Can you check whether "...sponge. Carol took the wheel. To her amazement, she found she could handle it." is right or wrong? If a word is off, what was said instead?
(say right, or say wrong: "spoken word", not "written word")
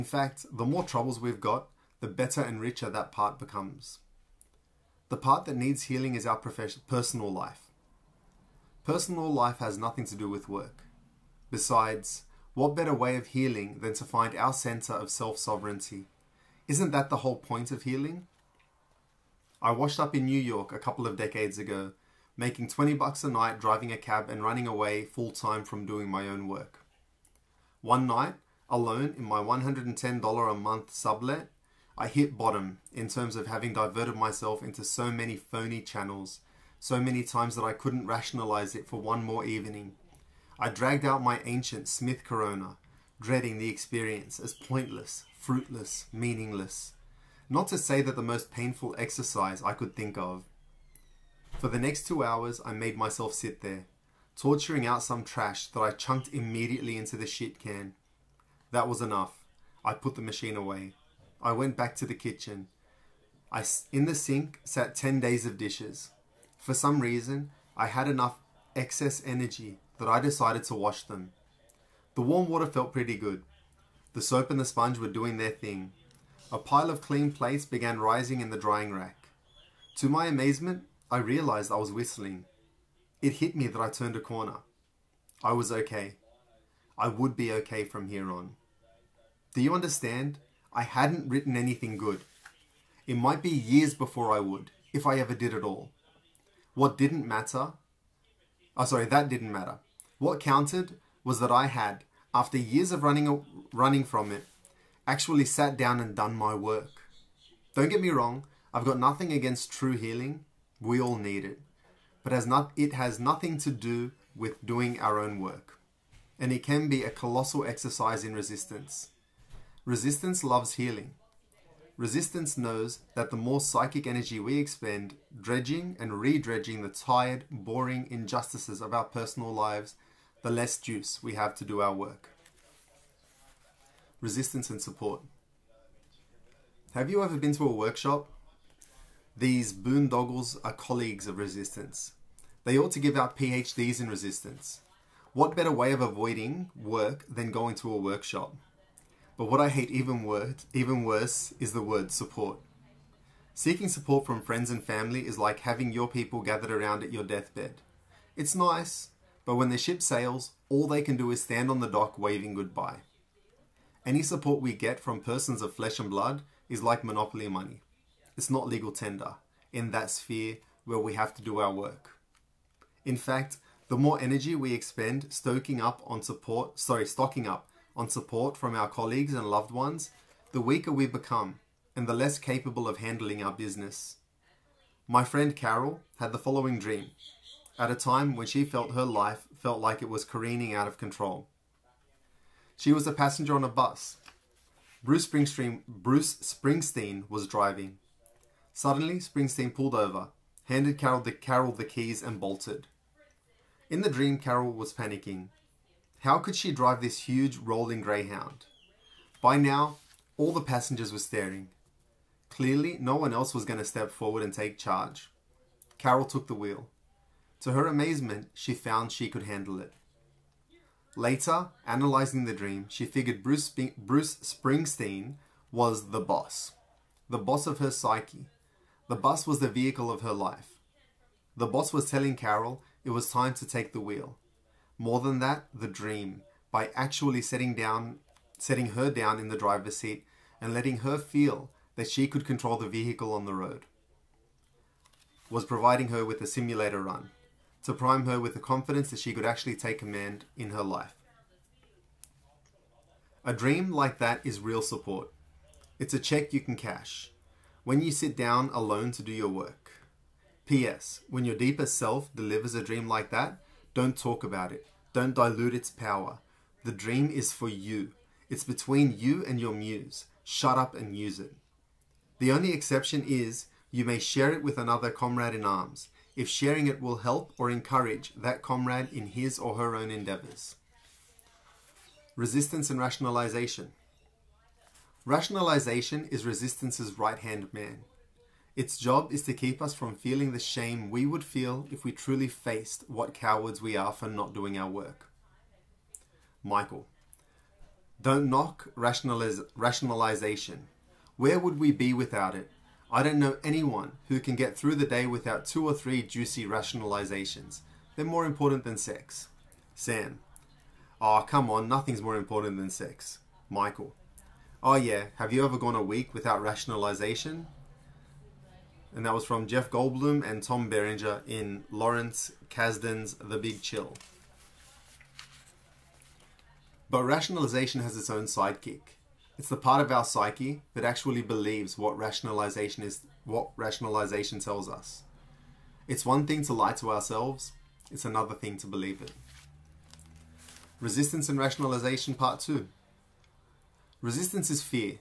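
wrong: "charge", not "sponge".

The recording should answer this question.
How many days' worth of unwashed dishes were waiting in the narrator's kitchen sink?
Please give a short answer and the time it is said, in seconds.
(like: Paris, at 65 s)
10, at 64 s.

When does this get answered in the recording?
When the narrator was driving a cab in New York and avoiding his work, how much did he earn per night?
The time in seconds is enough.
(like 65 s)
22 s.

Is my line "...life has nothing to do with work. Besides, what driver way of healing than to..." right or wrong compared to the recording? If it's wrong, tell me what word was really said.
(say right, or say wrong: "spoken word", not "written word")
wrong: "better", not "driver".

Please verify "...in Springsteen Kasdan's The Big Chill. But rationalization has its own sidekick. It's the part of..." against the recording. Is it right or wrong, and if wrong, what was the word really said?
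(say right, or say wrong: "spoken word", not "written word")
wrong: "Lawrence", not "Springsteen".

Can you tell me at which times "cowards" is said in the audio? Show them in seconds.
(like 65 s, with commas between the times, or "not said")
293 s.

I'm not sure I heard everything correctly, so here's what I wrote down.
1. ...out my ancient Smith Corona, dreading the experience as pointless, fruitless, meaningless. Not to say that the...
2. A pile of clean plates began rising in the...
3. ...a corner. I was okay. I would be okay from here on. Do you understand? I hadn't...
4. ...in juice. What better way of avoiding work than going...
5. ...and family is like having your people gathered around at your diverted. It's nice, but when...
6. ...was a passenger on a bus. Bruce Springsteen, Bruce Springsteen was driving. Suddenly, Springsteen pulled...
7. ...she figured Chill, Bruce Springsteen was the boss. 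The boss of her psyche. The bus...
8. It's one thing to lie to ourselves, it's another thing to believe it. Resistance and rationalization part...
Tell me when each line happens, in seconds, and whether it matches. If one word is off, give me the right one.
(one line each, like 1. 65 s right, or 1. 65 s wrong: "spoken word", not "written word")
1. 41 s right
2. 76 s right
3. 84 s right
4. 144 s wrong: "resistance", not "juice"
5. 154 s wrong: "deathbed", not "diverted"
6. 192 s right
7. 222 s wrong: "Bruce", not "Chill"
8. 336 s right.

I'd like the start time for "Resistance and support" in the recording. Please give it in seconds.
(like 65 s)
134 s.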